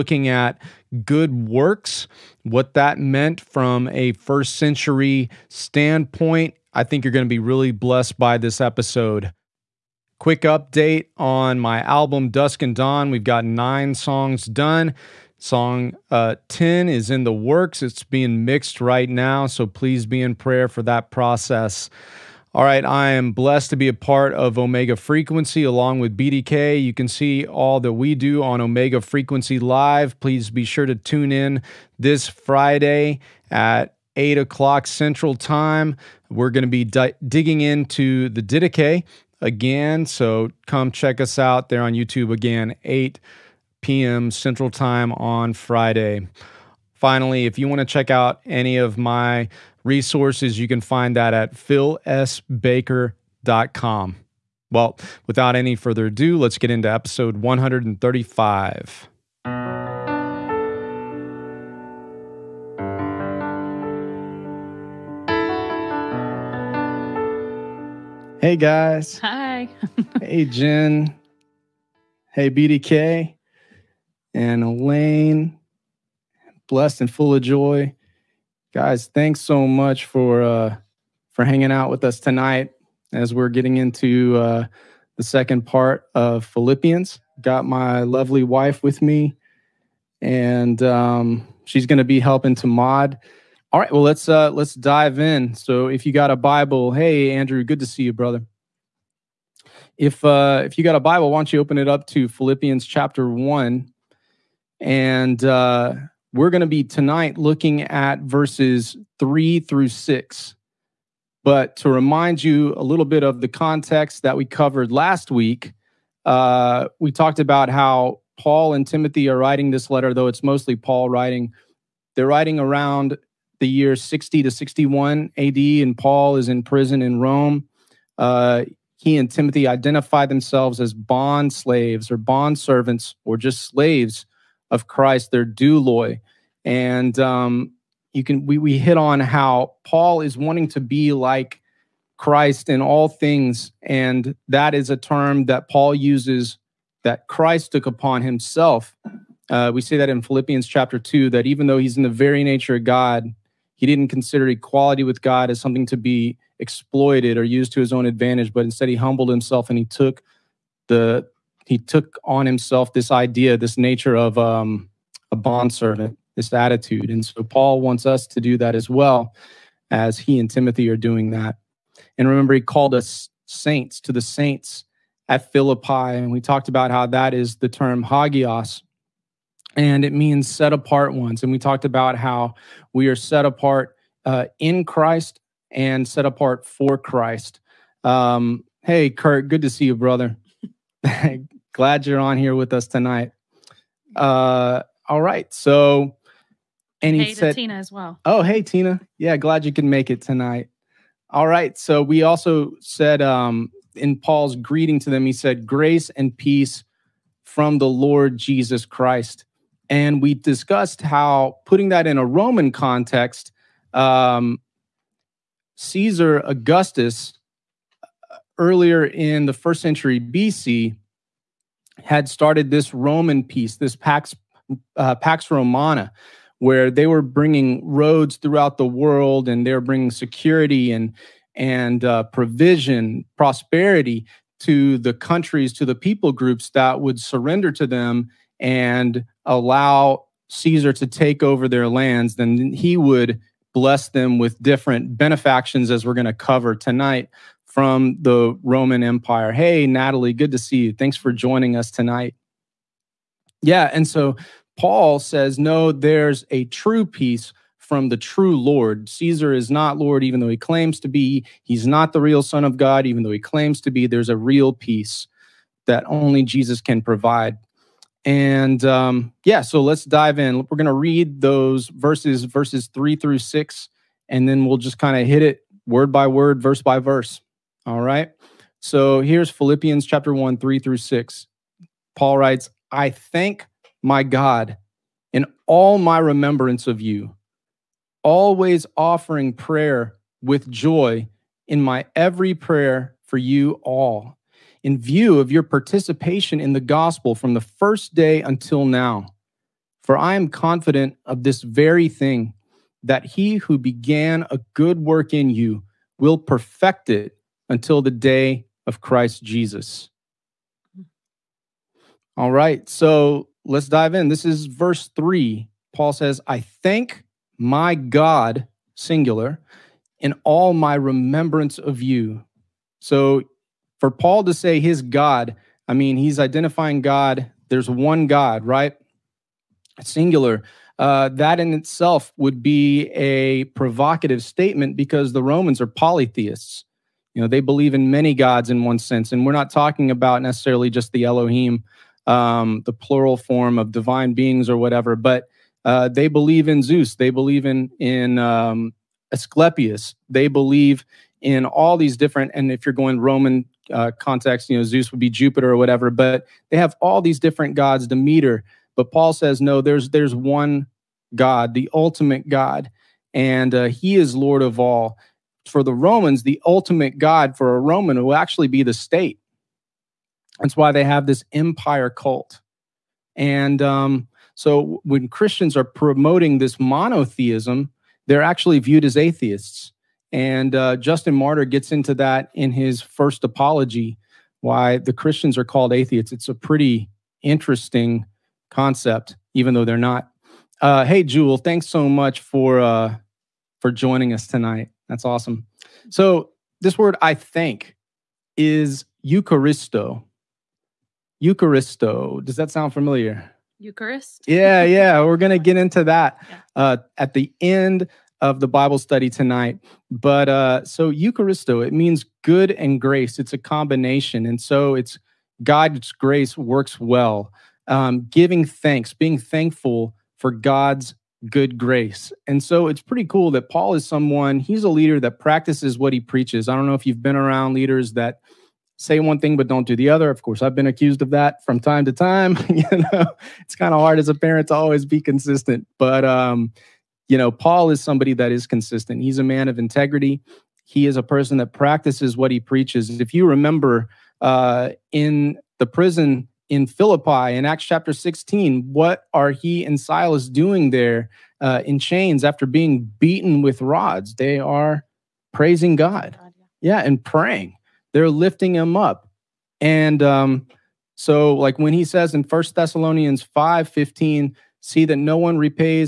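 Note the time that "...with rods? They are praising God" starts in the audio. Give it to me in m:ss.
7:33.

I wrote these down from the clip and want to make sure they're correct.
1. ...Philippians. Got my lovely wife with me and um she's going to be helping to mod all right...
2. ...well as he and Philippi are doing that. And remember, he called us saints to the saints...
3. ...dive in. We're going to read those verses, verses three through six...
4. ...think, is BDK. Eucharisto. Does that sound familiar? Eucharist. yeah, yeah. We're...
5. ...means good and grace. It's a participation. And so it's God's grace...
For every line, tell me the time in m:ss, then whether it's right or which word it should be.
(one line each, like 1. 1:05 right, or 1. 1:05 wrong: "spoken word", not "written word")
1. 1:26 right
2. 2:48 wrong: "Timothy", not "Philippi"
3. 4:30 right
4. 6:37 wrong: "Eucharisto", not "BDK"
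5. 6:51 wrong: "combination", not "participation".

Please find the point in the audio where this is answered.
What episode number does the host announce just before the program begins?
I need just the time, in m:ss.
0:56.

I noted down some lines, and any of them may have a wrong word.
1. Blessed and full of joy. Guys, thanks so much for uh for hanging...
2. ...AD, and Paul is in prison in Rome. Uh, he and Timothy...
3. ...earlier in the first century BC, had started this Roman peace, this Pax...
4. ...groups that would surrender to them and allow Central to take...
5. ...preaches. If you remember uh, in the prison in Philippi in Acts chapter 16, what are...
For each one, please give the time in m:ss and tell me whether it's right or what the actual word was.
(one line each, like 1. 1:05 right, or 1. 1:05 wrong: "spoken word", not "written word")
1. 1:16 right
2. 2:05 right
3. 3:38 right
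4. 3:56 wrong: "Caesar", not "Central"
5. 7:22 right.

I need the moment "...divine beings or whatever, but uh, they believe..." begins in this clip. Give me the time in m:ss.
5:43.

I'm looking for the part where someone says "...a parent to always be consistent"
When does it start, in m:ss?
7:14.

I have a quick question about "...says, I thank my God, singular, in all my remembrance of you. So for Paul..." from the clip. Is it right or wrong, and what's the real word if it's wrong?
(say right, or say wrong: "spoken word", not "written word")
right.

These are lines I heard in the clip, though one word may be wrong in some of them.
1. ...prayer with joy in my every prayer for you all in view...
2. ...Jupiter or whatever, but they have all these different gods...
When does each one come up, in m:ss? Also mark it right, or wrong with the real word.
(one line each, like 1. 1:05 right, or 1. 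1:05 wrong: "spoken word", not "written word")
1. 4:49 right
2. 5:55 right.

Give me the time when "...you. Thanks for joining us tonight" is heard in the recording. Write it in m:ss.
4:10.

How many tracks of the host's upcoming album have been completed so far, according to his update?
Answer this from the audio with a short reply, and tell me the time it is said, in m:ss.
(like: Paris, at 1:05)
9, at 0:13.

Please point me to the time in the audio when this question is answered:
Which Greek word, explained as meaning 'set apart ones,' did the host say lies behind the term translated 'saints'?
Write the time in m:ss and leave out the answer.
2:58.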